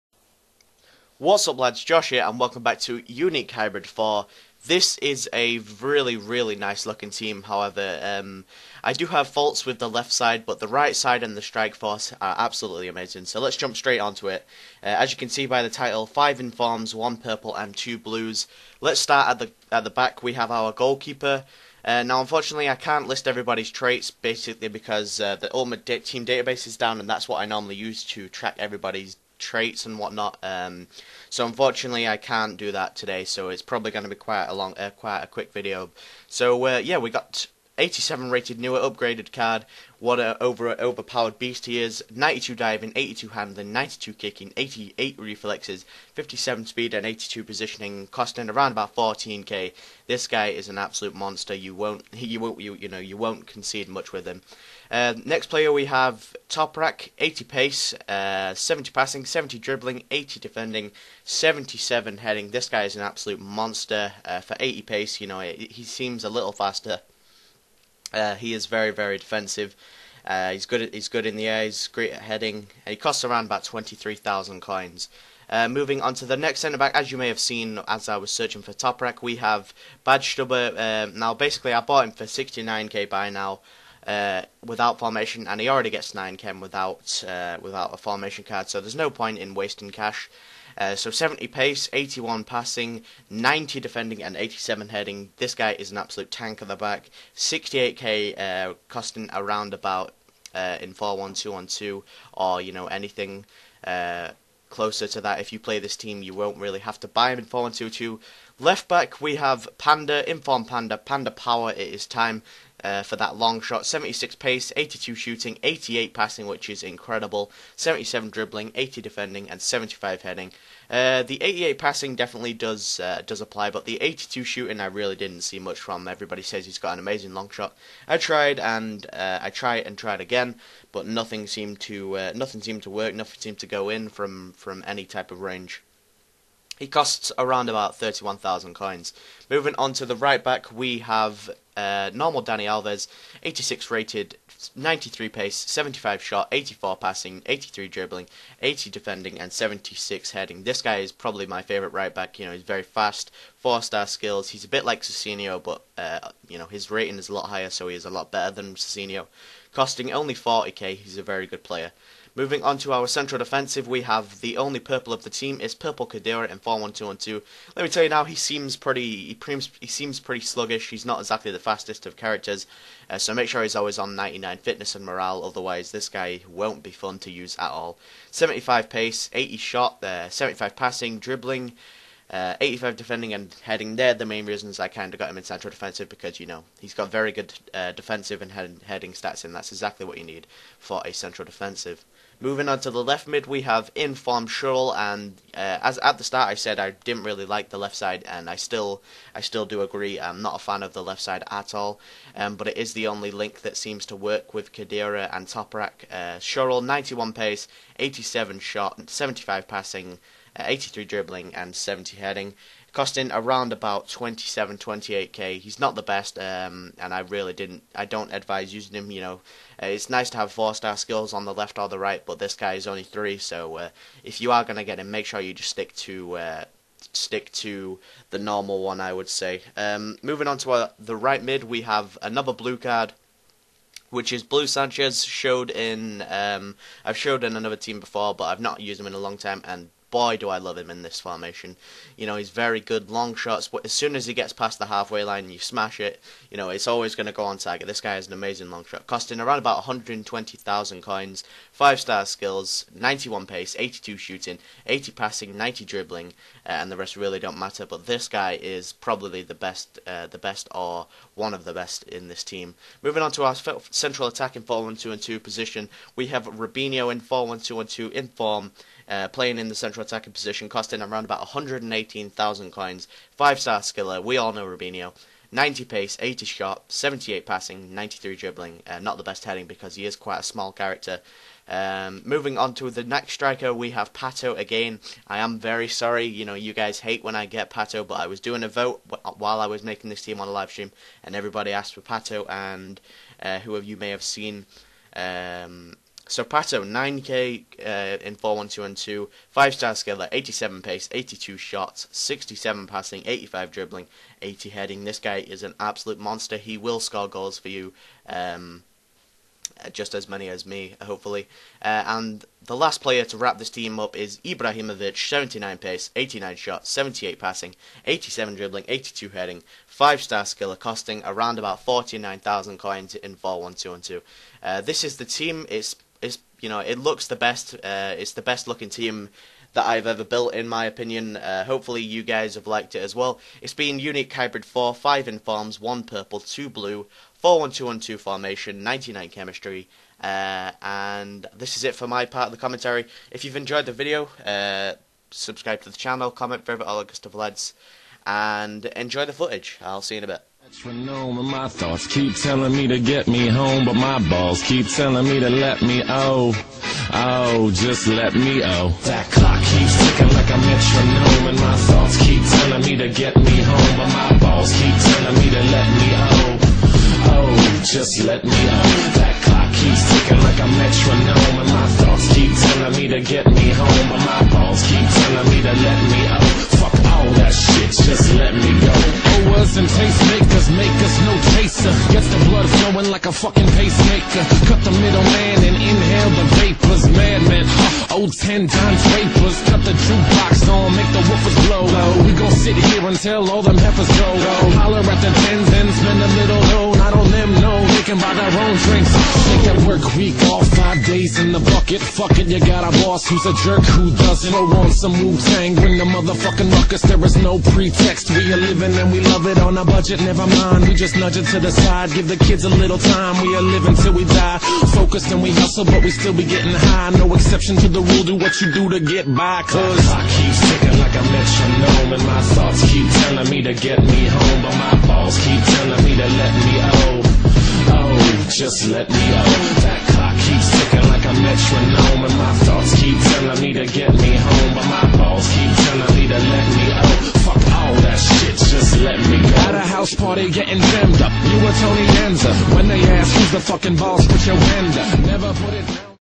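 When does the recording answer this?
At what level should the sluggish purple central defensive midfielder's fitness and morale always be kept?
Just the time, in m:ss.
2:54.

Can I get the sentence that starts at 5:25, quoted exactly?
It's it's you know it looks the best.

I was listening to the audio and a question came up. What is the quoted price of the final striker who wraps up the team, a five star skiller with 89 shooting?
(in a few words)
49,000 coins.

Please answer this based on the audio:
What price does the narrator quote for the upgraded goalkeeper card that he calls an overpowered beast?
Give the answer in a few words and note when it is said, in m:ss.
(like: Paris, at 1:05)
14k, at 0:48.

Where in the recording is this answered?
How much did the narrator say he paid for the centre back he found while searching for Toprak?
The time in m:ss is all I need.
1:22.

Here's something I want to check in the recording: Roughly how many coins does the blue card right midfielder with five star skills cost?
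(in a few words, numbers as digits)
120,000.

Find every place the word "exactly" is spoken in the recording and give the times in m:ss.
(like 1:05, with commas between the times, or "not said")
2:51, 3:09.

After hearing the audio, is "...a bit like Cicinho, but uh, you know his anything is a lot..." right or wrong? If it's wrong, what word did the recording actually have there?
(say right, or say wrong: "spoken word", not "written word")
wrong: "rating", not "anything".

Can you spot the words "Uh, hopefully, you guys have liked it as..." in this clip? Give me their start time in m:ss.
5:31.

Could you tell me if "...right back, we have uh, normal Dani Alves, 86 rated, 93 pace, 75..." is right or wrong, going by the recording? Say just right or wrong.
right.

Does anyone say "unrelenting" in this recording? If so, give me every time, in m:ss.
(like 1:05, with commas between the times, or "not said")
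not said.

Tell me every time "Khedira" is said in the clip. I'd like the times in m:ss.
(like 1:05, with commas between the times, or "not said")
2:46, 3:24.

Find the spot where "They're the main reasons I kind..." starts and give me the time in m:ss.
3:03.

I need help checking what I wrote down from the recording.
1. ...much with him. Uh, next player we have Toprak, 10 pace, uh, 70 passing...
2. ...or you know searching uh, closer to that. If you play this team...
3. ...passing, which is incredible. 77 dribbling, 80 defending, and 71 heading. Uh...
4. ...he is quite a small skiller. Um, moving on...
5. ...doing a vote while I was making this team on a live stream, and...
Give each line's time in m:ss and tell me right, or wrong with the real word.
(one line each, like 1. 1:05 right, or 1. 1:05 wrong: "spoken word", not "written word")
1. 0:53 wrong: "80", not "10"
2. 1:42 wrong: "anything", not "searching"
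3. 1:56 wrong: "75", not "71"
4. 4:39 wrong: "character", not "skiller"
5. 4:48 right.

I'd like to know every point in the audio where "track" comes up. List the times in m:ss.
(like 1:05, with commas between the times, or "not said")
0:28.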